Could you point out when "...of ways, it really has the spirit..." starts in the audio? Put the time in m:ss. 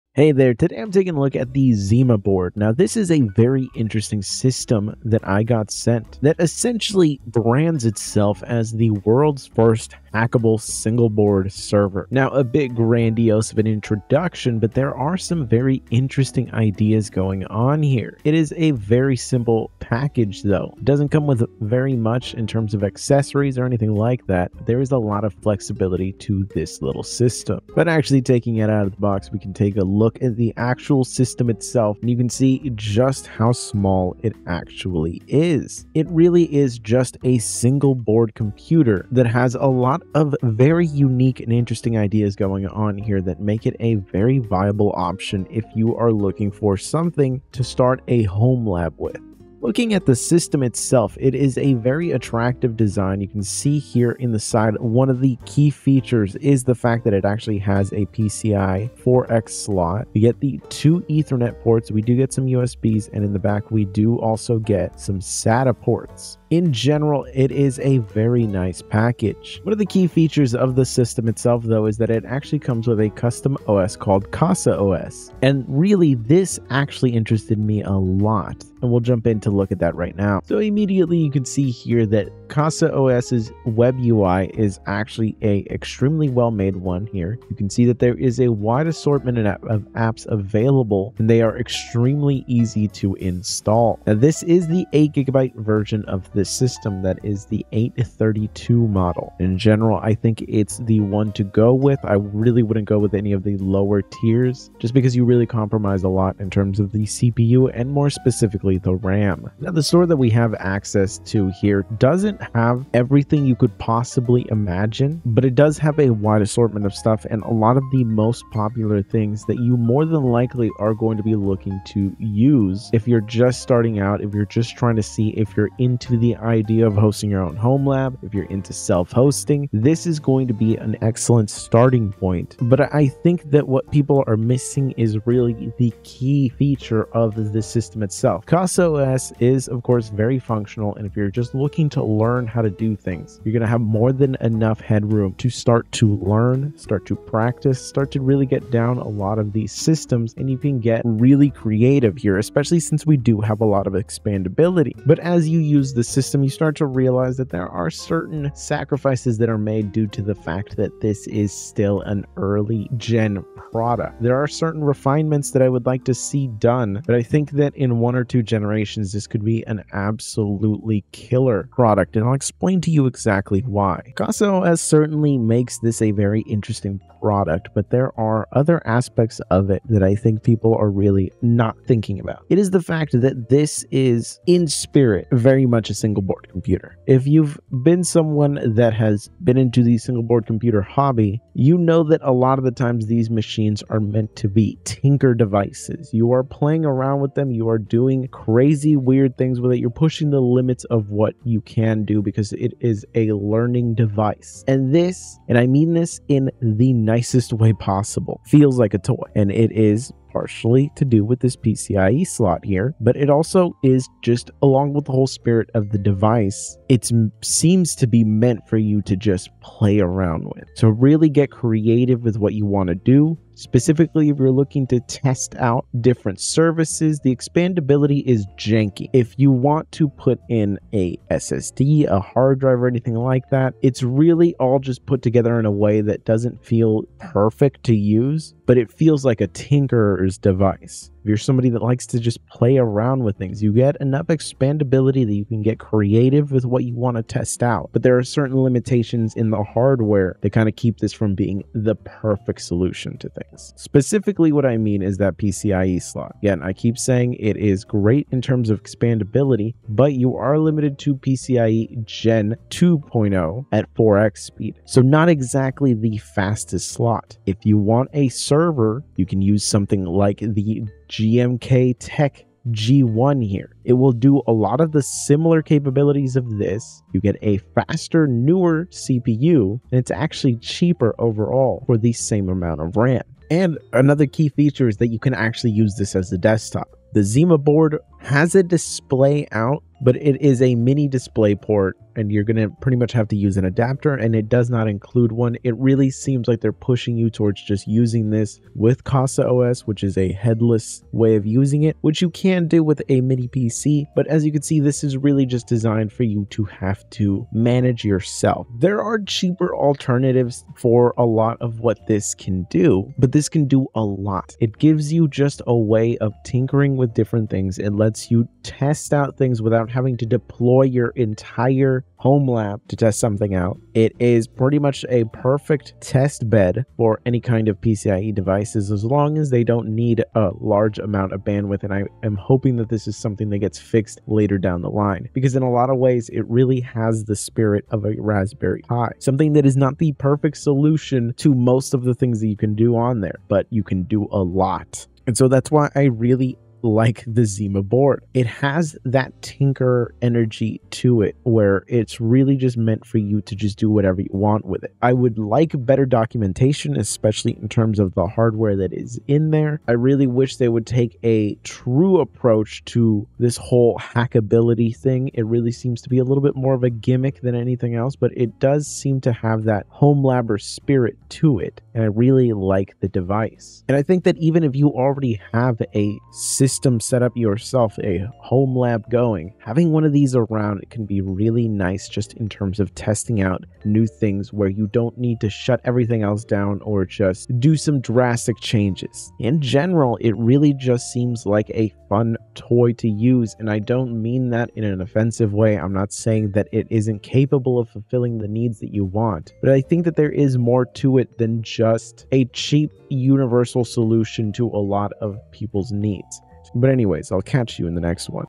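5:35.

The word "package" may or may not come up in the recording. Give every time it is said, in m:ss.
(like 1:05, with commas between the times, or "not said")
0:19, 1:08.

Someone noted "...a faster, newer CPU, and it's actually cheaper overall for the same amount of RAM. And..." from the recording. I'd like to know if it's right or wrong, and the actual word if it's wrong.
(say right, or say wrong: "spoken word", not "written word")
right.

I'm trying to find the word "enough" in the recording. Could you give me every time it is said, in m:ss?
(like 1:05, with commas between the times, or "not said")
2:24, 4:04.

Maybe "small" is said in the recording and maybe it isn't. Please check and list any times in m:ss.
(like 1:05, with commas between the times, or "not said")
0:33.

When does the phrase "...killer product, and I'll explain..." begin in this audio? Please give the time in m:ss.
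2:51.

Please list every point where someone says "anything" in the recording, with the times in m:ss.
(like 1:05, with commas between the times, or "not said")
0:23, 3:52, 6:07.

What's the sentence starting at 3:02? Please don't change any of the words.
It is the fact that this is, in spirit, very much a single single board computer.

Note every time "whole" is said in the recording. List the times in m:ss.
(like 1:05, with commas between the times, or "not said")
3:35, 6:03.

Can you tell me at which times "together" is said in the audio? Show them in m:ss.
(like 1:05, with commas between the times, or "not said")
3:55.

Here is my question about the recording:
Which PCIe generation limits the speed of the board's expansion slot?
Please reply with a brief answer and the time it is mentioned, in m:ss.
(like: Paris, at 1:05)
Gen 2.0, at 4:22.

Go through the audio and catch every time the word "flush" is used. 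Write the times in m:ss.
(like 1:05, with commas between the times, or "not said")
not said.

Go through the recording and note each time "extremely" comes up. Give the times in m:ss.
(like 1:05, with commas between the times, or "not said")
1:25, 1:31.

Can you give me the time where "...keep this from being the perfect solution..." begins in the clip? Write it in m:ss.
4:10.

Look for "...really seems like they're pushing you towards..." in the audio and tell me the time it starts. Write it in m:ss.
4:55.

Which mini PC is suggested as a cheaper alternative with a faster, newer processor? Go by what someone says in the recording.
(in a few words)
GMKtec G1.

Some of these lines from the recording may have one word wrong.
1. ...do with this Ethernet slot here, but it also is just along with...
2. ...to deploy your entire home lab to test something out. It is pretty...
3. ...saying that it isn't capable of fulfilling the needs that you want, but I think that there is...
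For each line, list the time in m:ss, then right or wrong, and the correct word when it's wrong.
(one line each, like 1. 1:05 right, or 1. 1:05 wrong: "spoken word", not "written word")
1. 3:31 wrong: "PCIe", not "Ethernet"
2. 5:20 right
3. 6:36 right.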